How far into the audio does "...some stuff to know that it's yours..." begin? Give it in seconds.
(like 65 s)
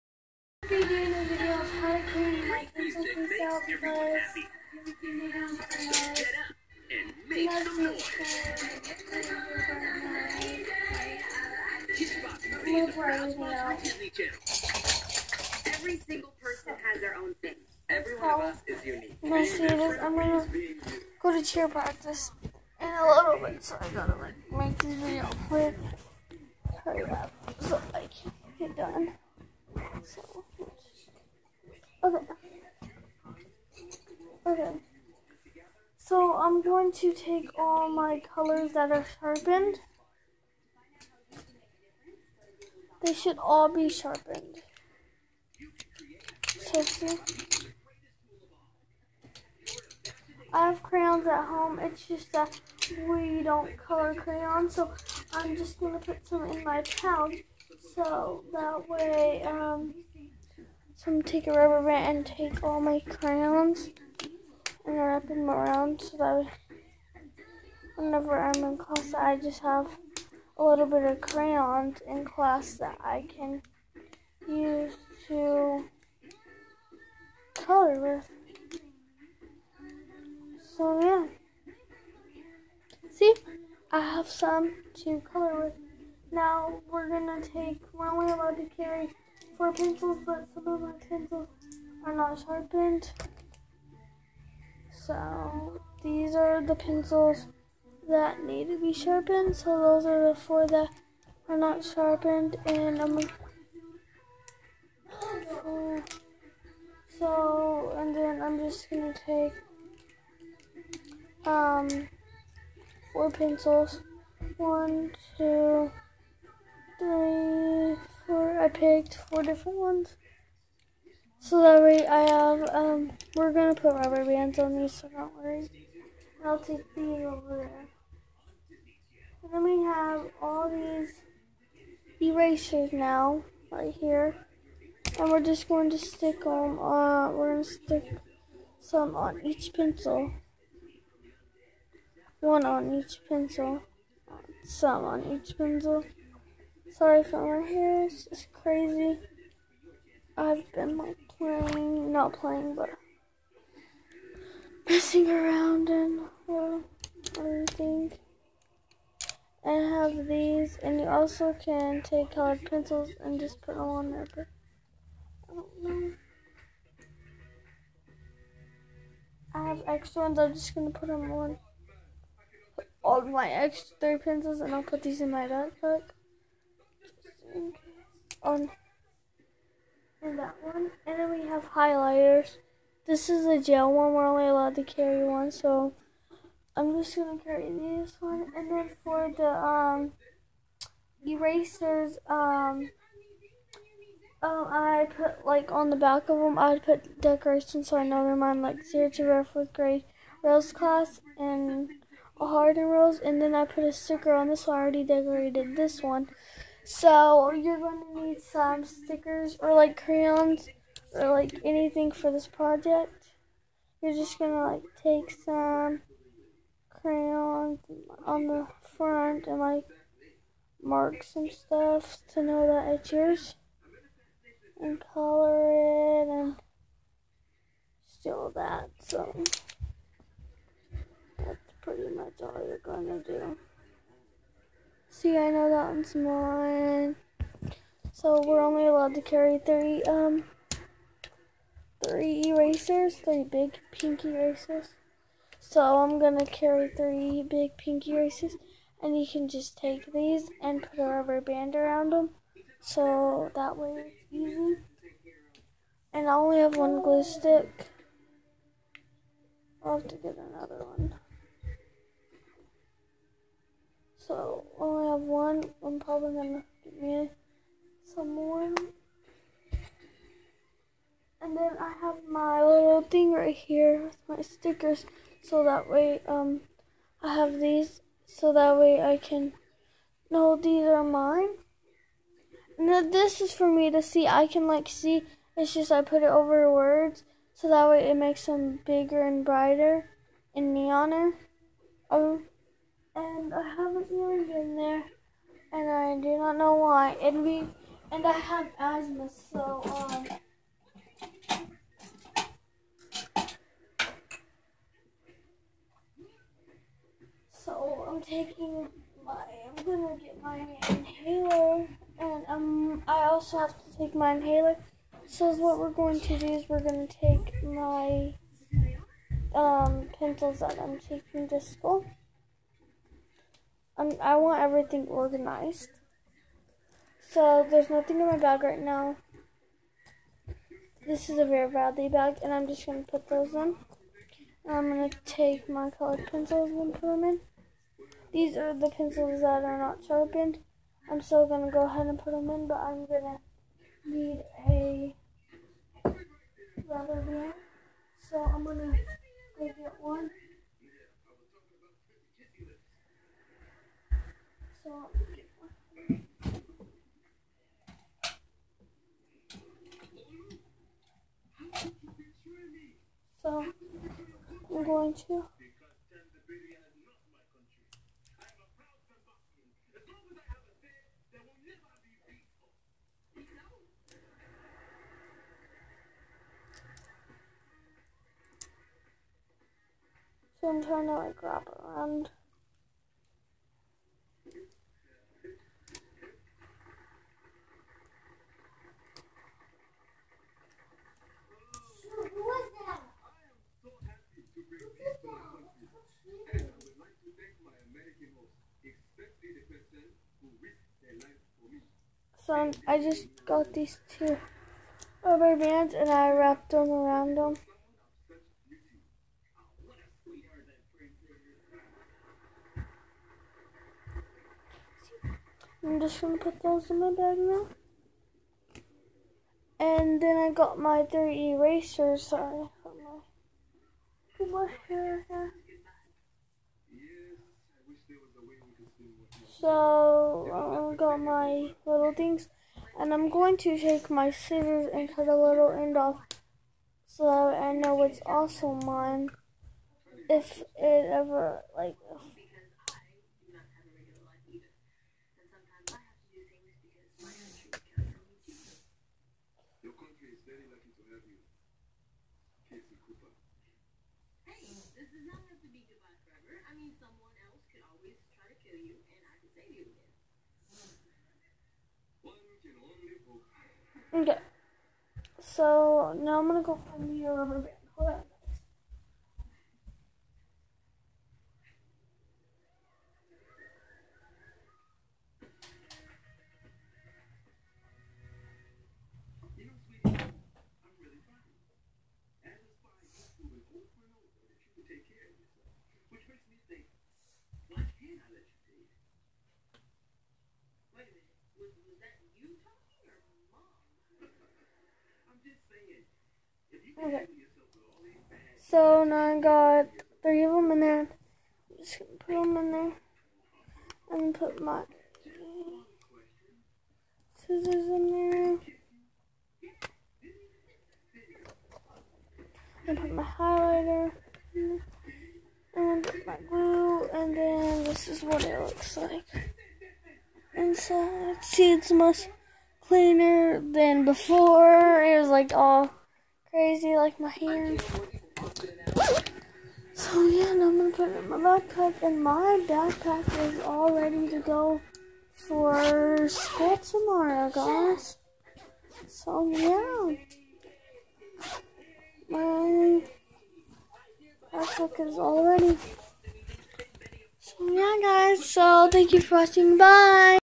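221 s.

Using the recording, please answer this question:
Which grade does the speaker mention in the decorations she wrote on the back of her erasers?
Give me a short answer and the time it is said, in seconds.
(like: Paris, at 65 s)
fourth grade, at 199 s.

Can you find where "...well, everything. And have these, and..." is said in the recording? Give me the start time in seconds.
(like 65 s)
156 s.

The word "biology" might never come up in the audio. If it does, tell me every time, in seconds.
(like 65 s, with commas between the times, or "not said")
not said.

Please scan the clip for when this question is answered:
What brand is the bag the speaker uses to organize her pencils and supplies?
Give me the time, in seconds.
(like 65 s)
331 s.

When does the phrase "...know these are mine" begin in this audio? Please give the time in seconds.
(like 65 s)
280 s.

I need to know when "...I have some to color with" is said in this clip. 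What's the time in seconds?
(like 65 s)
83 s.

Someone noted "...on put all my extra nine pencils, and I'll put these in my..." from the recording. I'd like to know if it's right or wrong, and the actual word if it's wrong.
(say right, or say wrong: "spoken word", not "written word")
wrong: "three", not "nine".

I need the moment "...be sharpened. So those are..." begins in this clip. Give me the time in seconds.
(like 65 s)
98 s.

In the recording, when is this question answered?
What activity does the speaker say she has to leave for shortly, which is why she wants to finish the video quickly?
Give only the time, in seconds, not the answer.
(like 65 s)
21 s.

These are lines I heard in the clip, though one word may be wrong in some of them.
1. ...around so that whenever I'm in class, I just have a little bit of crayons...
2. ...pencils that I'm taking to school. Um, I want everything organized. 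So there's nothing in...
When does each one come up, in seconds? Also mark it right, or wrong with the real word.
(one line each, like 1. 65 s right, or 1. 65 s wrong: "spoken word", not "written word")
1. 65 s right
2. 320 s right.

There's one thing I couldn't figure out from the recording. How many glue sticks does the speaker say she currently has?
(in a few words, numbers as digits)
1.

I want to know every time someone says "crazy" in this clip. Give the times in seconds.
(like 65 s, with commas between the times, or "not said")
148 s, 526 s.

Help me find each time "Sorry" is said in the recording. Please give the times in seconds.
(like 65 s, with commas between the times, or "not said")
146 s, 422 s.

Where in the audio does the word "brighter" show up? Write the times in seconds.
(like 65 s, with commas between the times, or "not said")
289 s.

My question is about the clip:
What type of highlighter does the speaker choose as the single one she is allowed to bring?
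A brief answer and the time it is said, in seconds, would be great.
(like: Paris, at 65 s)
gel, at 183 s.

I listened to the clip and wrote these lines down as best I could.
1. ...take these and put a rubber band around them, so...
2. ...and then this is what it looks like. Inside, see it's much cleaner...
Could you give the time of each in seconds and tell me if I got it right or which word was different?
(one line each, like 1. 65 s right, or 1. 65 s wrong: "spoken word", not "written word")
1. 249 s right
2. 517 s right.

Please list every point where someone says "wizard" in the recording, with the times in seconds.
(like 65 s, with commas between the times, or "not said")
not said.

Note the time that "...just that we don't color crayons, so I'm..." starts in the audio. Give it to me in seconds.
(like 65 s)
52 s.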